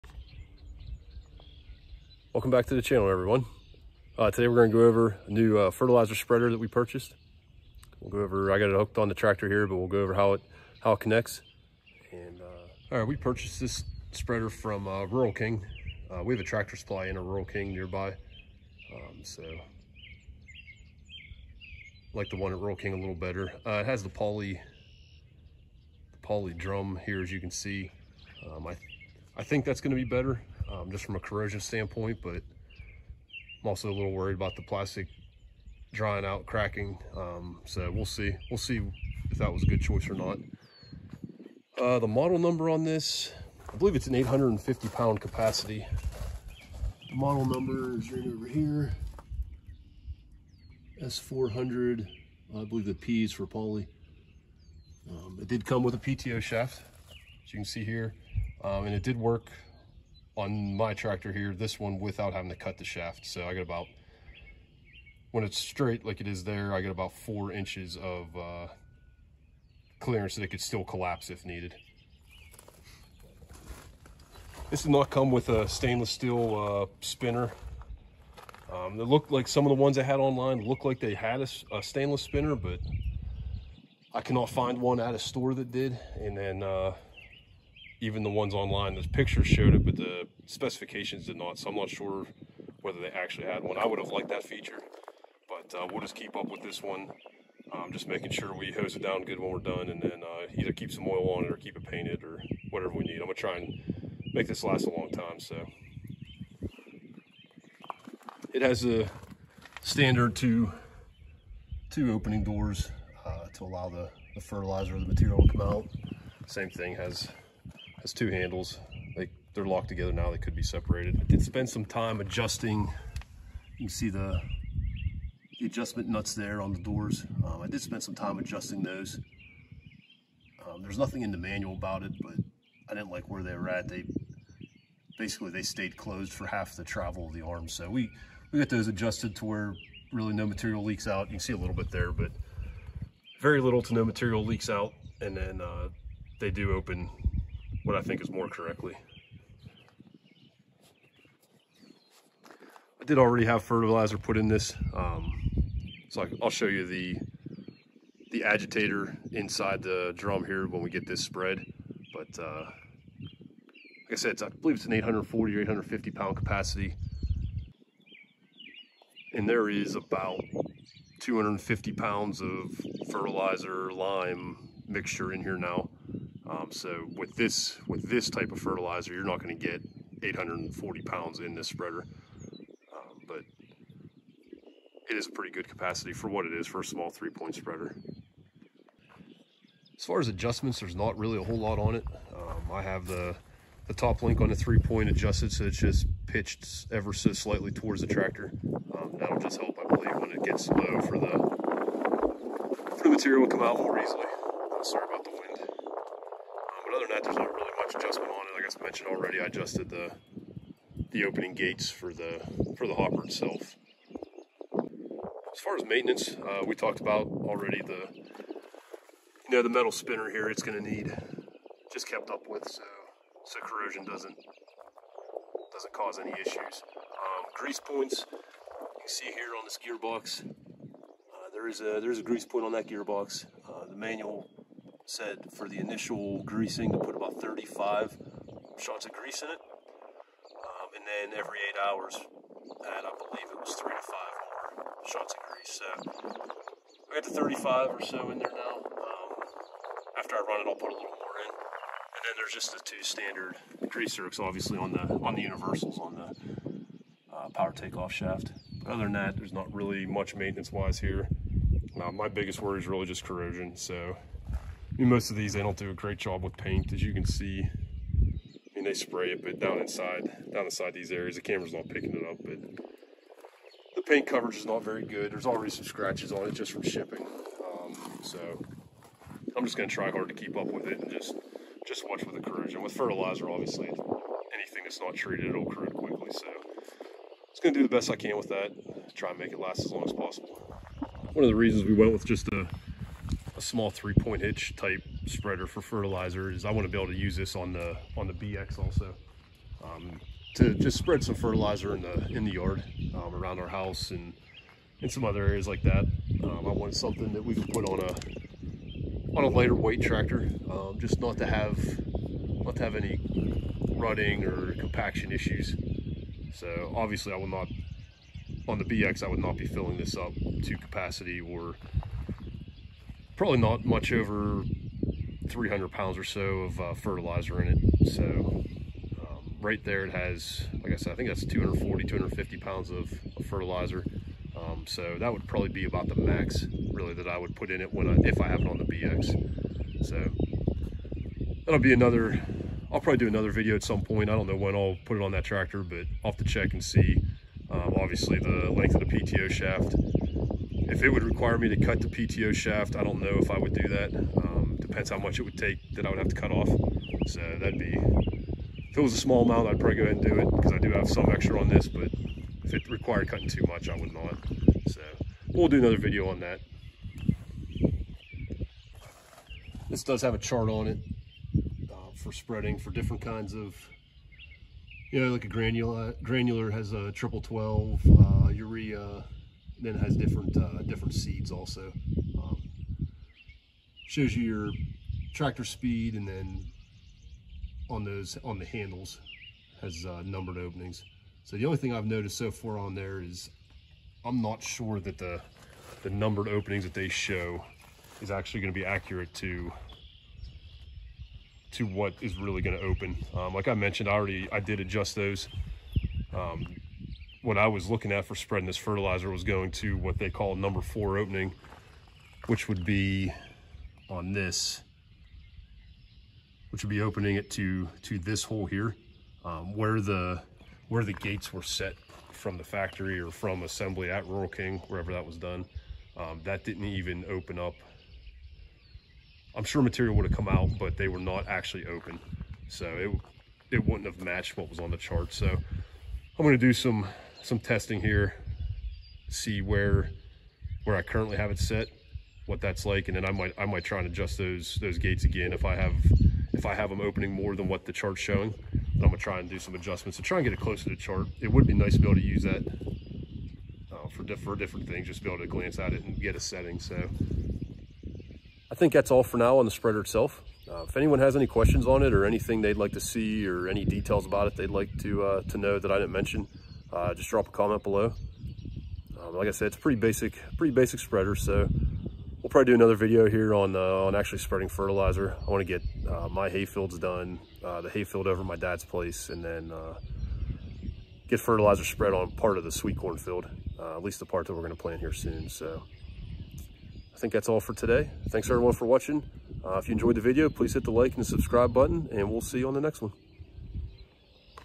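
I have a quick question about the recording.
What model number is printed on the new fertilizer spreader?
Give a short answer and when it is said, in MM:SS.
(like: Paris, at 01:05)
S400, at 00:51.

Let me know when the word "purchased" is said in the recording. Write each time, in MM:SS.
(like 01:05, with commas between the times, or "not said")
00:06, 00:13.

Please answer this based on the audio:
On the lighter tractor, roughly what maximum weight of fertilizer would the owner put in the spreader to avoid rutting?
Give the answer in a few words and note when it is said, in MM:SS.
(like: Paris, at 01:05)
300 pounds, at 05:25.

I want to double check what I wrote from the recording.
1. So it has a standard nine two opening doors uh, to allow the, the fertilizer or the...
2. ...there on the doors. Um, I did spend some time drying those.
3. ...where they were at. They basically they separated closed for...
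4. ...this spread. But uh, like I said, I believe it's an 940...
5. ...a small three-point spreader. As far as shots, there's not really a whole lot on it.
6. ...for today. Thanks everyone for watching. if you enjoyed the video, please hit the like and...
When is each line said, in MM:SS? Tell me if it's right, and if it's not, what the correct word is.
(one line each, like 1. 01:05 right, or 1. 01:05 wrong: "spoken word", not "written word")
1. 01:45 wrong: "two", not "nine"
2. 02:06 wrong: "adjusting", not "drying"
3. 02:13 wrong: "stayed", not "separated"
4. 02:41 wrong: "840", not "940"
5. 03:06 wrong: "adjustments", not "shots"
6. 08:07 right.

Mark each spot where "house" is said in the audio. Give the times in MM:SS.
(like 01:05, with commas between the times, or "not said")
05:03.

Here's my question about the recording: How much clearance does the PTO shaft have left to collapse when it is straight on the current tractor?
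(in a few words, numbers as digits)
4 inches.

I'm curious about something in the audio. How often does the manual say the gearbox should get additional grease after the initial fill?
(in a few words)
every 8 hours.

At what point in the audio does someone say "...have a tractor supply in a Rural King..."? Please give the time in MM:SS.
00:16.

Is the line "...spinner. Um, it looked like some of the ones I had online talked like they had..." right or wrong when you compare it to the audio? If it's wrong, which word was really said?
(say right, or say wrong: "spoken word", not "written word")
wrong: "looked", not "talked".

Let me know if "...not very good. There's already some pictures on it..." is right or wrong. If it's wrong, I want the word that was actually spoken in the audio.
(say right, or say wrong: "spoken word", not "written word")
wrong: "scratches", not "pictures".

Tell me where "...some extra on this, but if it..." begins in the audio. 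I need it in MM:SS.
06:01.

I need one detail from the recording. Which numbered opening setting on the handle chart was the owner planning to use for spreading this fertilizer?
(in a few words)
number 4.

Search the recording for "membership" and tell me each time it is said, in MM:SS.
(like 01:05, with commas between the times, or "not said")
not said.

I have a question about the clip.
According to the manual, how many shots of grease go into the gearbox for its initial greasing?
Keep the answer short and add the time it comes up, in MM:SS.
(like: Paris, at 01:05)
35, at 03:57.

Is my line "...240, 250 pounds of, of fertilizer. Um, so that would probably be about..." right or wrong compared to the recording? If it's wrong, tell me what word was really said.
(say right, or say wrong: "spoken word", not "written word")
right.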